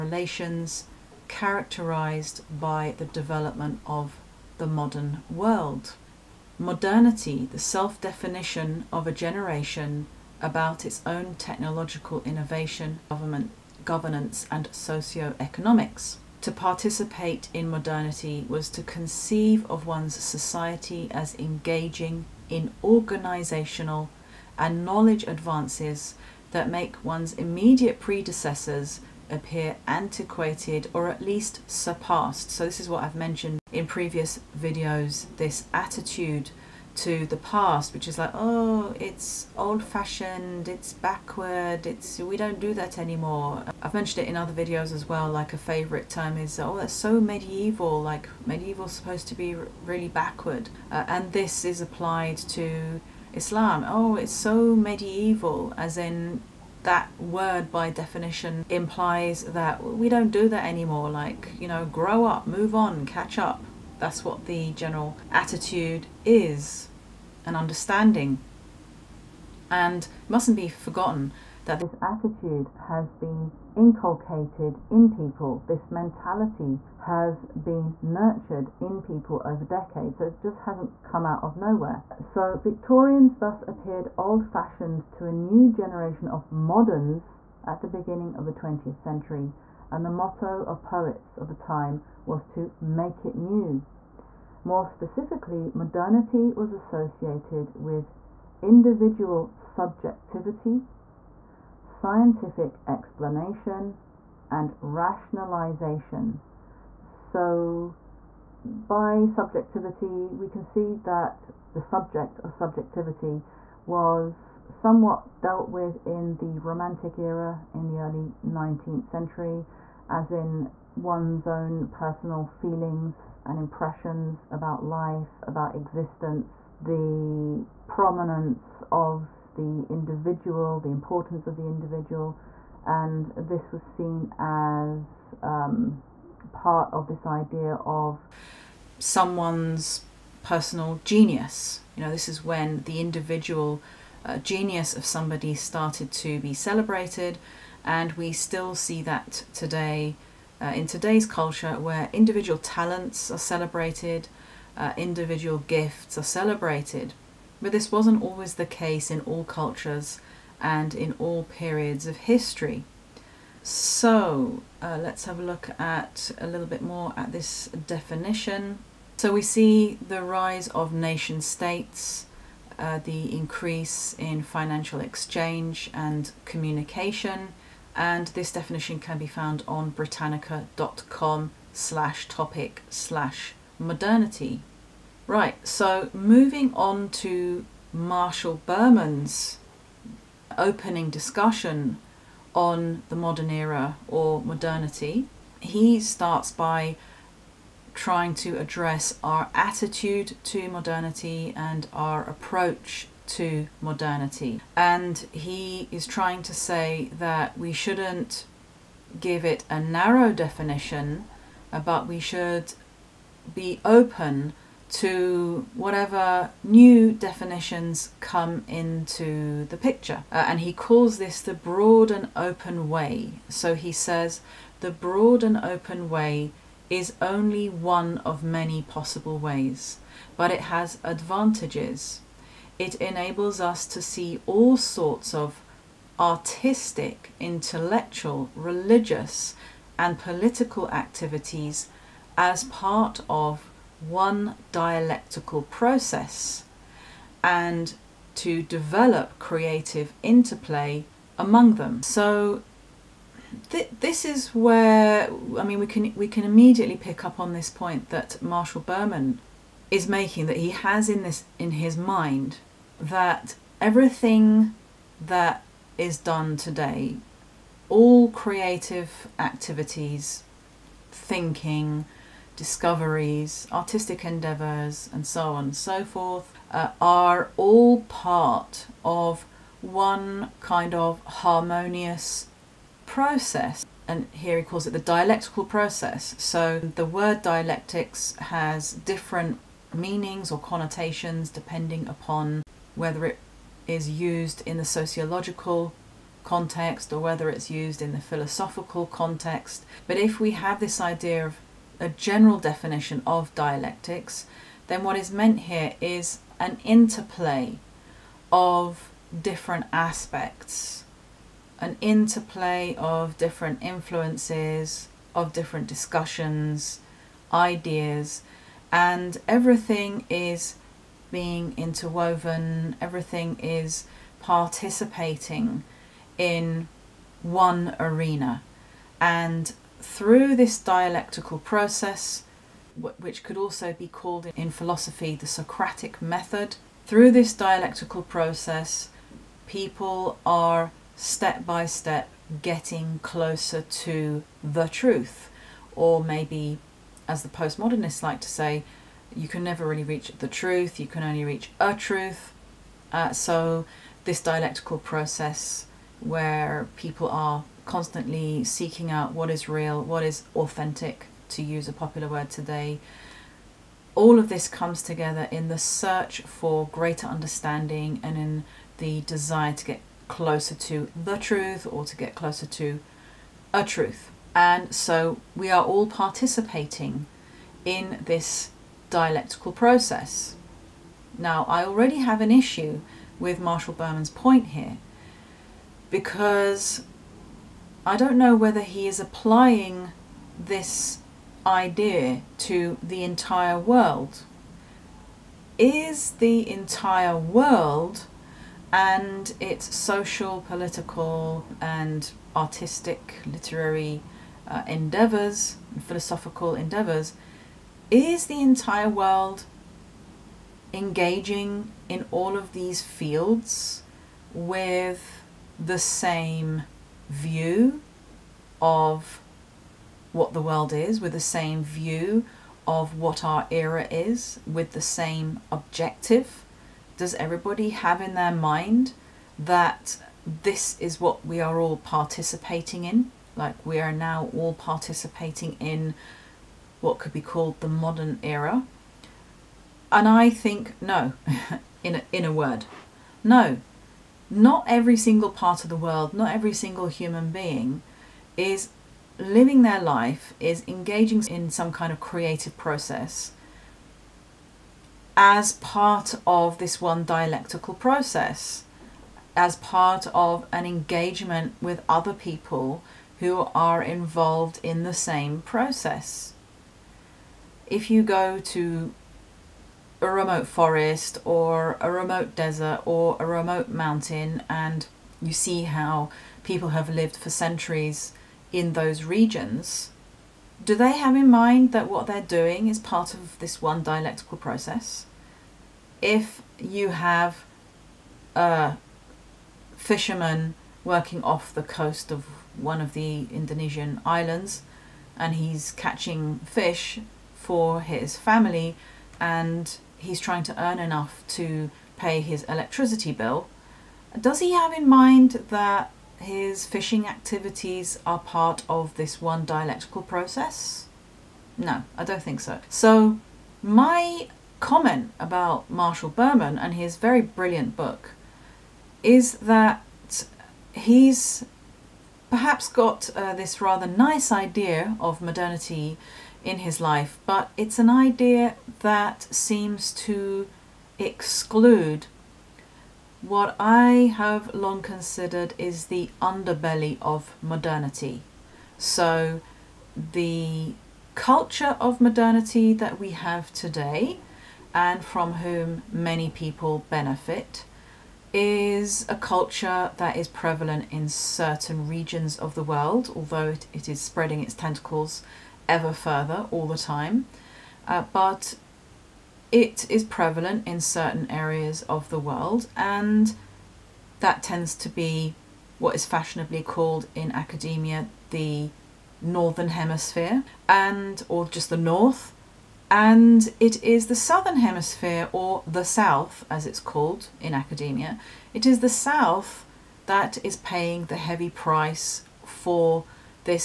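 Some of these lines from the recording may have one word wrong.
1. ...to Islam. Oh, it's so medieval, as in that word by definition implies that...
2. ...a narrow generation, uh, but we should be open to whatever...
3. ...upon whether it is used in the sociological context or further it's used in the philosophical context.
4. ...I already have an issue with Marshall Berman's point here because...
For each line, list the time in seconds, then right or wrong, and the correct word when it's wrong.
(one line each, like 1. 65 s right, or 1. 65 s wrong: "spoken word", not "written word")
1. 52 s right
2. 209 s wrong: "definition", not "generation"
3. 292 s wrong: "whether", not "further"
4. 381 s right.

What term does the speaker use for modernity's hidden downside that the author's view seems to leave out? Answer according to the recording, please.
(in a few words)
the underbelly of modernity.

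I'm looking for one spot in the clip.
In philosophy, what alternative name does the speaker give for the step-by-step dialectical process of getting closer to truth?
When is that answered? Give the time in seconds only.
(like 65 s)
335 s.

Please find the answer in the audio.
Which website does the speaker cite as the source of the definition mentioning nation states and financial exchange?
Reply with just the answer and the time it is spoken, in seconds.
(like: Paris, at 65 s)
britannica.com, at 179 s.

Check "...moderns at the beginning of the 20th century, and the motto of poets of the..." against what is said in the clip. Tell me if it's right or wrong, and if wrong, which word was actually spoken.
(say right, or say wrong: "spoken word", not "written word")
right.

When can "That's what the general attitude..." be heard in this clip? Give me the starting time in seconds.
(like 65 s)
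64 s.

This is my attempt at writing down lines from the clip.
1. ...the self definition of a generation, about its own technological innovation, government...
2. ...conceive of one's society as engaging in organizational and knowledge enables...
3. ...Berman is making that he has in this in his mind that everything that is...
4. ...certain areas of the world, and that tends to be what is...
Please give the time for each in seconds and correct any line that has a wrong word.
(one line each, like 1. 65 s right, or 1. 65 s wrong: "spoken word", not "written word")
1. 7 s right
2. 18 s wrong: "advances", not "enables"
3. 258 s right
4. 560 s right.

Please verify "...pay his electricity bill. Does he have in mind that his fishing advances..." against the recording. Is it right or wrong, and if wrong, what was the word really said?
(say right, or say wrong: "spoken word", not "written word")
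wrong: "activities", not "advances".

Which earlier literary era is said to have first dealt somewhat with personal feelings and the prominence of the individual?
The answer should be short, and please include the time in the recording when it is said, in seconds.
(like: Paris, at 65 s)
the Romantic era, at 116 s.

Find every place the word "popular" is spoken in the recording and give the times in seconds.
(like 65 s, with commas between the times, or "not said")
361 s.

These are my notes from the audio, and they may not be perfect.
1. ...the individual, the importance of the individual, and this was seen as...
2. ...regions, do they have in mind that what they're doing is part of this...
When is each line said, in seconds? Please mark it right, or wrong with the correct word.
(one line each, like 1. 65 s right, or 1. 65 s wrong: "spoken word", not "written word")
1. 129 s right
2. 479 s right.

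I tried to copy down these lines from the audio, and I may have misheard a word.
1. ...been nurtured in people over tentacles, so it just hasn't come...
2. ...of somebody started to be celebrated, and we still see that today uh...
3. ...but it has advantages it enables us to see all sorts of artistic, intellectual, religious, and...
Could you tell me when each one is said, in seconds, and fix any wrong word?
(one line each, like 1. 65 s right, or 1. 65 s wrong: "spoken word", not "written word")
1. 77 s wrong: "decades", not "tentacles"
2. 144 s right
3. 230 s right.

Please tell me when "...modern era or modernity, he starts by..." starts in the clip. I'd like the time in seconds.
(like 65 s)
193 s.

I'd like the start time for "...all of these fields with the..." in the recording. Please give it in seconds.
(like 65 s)
412 s.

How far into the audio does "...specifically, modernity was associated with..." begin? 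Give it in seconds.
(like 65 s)
94 s.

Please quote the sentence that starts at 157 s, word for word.
But this wasn't always the case in all cultures and in all periods of history.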